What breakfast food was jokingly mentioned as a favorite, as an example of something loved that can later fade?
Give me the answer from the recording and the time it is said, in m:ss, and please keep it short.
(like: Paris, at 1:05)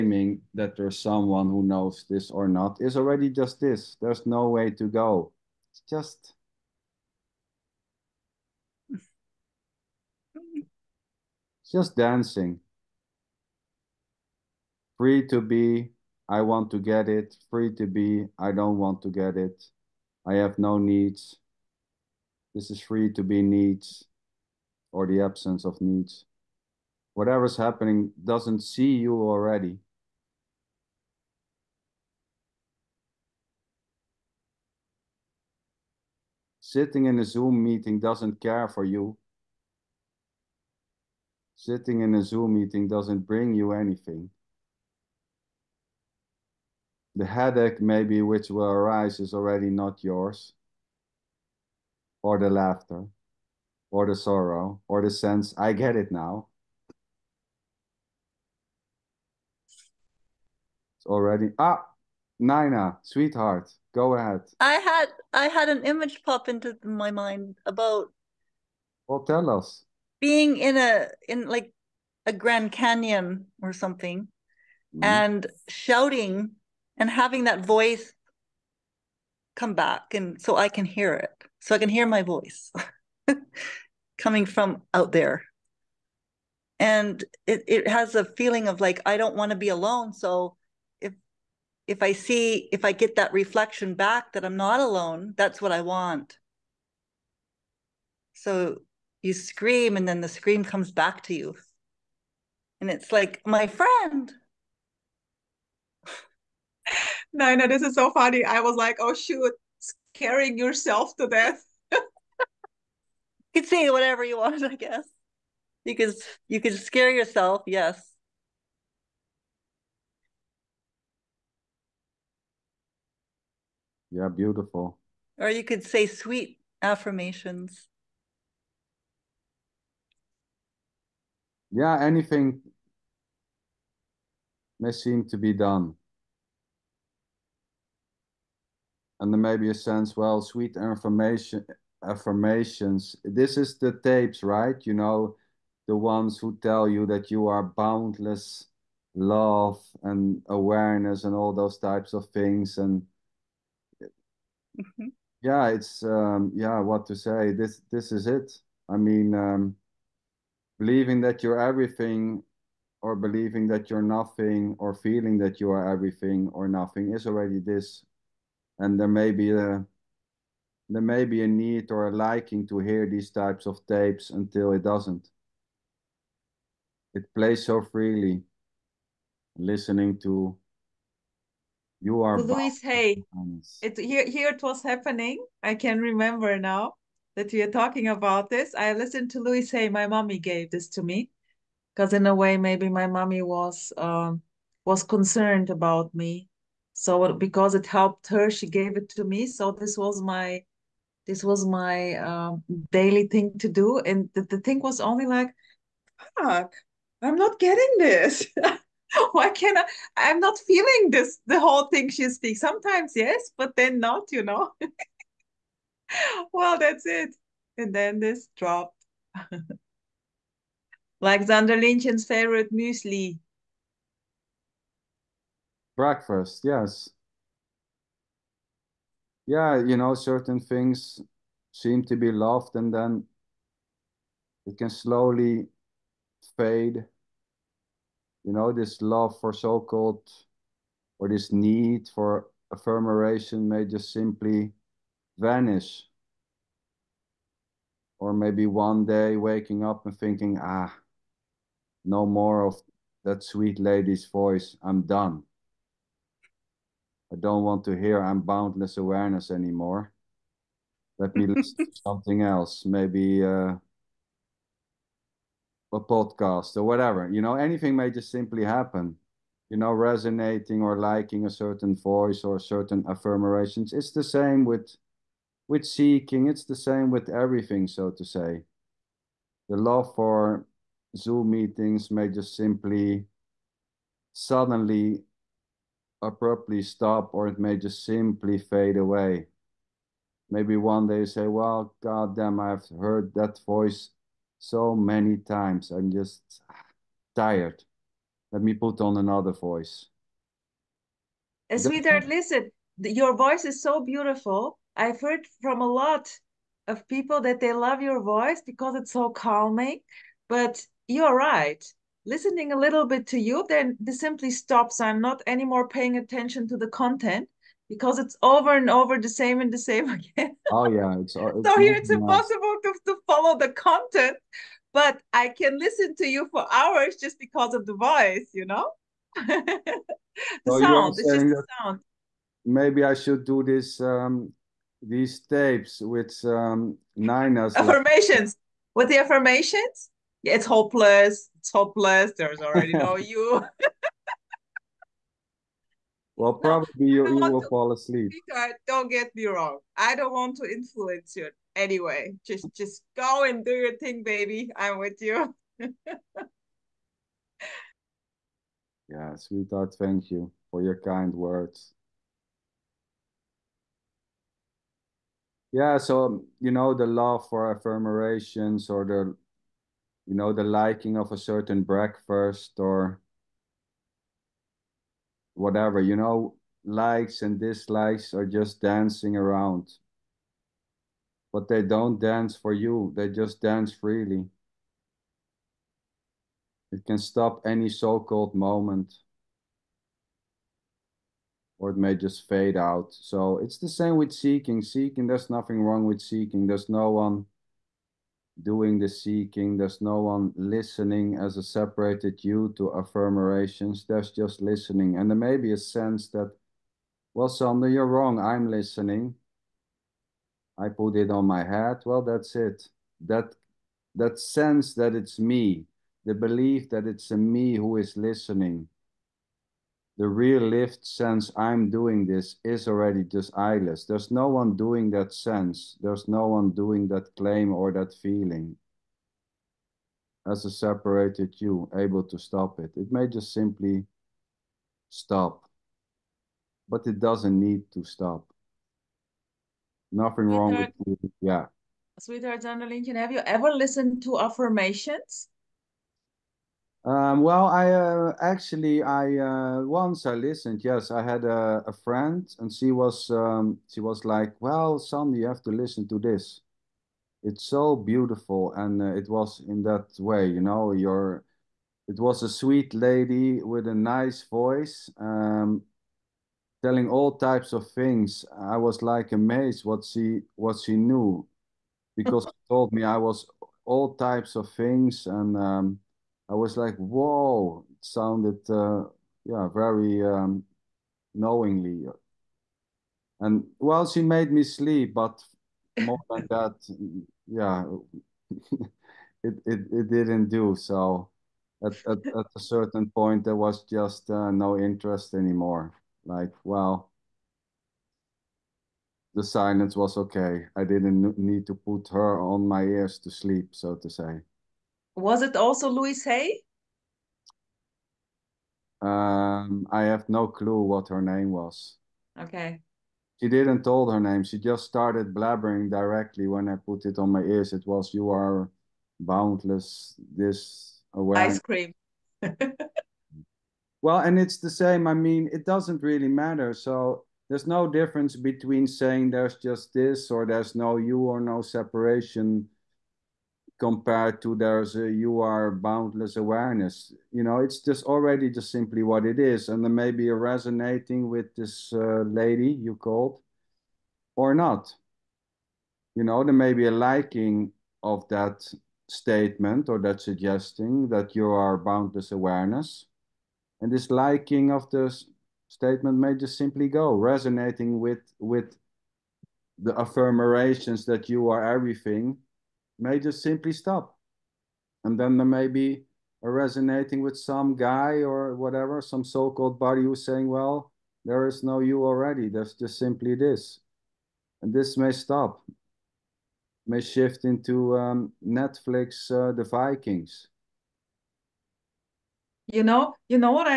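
Muesli, at 3:42.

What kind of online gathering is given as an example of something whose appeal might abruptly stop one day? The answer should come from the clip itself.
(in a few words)
Zoom meetings.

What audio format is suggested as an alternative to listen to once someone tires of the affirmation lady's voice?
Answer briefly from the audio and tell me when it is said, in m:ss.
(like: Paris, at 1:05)
A podcast, at 4:25.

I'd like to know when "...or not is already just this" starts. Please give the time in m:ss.
0:02.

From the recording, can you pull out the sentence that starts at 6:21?
But they don't dance for you, they just dance freely.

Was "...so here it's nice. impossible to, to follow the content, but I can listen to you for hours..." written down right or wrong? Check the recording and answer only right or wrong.
right.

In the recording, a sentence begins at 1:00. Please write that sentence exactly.
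It's already, ah, Nina, sweetheart, go ahead.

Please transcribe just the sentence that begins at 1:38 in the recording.
So you scream and then the scream comes back to you.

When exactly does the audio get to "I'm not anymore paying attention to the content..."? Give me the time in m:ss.
5:15.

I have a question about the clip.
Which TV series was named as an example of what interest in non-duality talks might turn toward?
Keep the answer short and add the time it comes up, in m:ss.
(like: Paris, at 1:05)
The Vikings, at 9:39.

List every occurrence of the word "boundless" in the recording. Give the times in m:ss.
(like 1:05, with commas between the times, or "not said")
2:27, 4:18, 8:39, 8:55, 9:11.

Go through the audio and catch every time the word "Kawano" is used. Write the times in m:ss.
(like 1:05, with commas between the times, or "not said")
not said.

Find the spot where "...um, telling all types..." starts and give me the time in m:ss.
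7:45.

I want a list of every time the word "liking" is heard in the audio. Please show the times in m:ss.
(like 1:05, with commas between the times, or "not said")
2:52, 4:30, 6:10, 9:06, 9:14.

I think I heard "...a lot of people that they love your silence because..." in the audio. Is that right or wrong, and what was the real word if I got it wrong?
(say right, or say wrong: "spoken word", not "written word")
wrong: "voice", not "silence".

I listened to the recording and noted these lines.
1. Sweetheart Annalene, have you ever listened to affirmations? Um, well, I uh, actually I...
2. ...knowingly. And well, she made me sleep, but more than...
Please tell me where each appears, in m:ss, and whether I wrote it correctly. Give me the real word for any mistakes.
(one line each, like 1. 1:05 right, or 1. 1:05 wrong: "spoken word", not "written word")
1. 7:22 right
2. 8:01 right.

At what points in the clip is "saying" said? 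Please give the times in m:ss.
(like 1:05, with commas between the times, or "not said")
8:48, 9:30.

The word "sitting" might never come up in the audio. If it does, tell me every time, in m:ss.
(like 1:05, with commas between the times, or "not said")
0:36, 0:41.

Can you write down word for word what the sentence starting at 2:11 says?
Yeah, anything may seem to be done.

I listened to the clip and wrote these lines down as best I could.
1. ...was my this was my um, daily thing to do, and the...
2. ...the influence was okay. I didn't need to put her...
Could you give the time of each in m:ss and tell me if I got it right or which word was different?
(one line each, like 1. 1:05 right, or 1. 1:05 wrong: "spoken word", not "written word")
1. 3:19 right
2. 8:19 wrong: "silence", not "influence".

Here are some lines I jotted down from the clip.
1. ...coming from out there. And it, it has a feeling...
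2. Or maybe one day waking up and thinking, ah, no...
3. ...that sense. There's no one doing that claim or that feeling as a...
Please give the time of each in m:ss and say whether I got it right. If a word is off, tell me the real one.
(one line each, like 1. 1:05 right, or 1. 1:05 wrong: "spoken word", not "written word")
1. 1:24 right
2. 4:08 right
3. 7:05 right.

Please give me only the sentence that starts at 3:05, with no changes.
I can remember now that we are talking about this.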